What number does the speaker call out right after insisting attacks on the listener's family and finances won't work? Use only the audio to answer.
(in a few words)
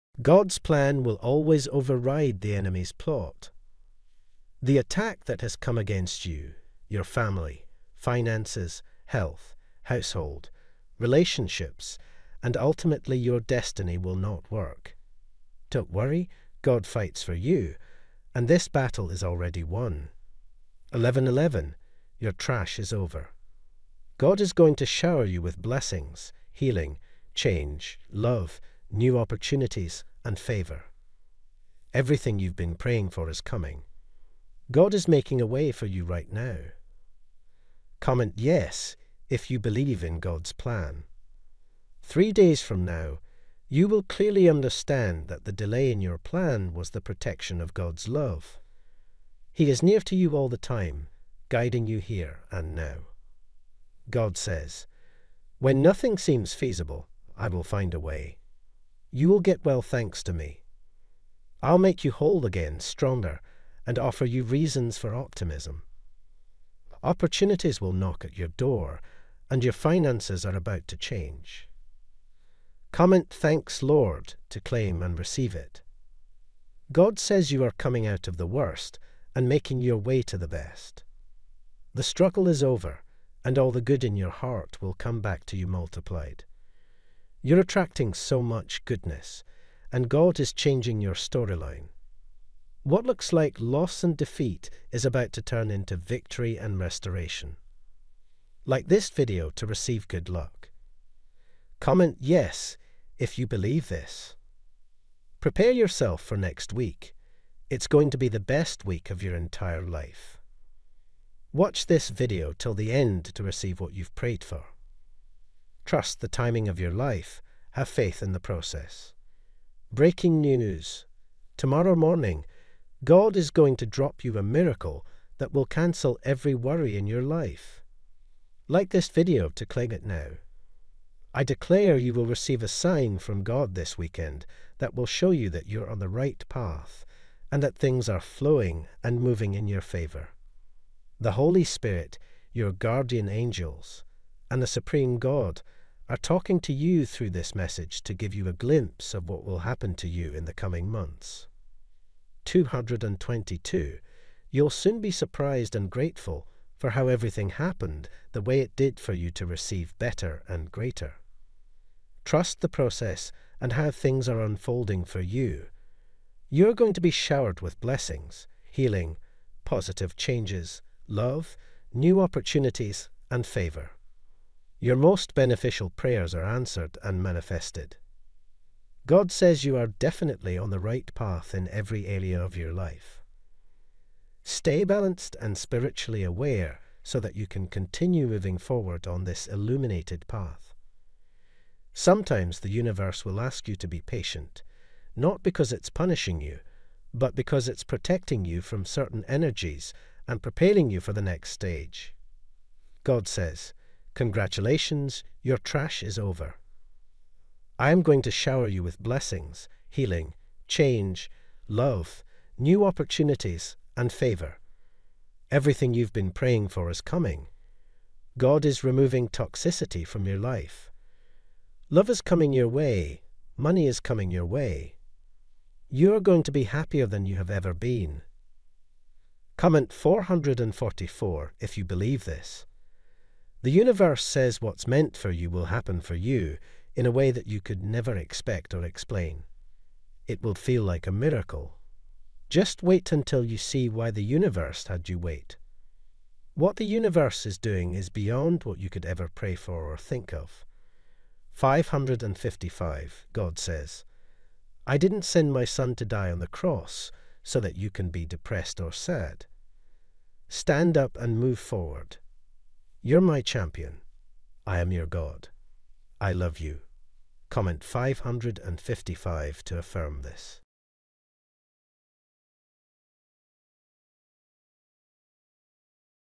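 1111.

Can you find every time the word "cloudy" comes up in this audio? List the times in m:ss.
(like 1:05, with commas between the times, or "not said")
not said.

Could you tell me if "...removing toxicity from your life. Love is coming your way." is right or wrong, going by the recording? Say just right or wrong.
right.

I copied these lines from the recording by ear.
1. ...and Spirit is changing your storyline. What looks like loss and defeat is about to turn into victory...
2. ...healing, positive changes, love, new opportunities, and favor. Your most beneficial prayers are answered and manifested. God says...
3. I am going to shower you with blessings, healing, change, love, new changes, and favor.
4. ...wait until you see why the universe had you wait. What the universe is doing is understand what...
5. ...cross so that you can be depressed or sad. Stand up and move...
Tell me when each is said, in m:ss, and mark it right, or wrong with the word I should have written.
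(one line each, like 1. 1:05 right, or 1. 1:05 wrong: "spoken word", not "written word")
1. 1:29 wrong: "God", not "Spirit"
2. 2:48 right
3. 3:27 wrong: "opportunities", not "changes"
4. 4:02 wrong: "beyond", not "understand"
5. 4:16 right.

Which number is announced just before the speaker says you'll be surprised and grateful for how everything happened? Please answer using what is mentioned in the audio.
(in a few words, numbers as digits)
222.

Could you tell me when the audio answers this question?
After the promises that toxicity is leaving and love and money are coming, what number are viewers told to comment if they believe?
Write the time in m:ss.
3:49.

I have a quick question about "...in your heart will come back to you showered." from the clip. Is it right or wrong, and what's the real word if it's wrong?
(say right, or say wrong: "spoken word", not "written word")
wrong: "multiplied", not "showered".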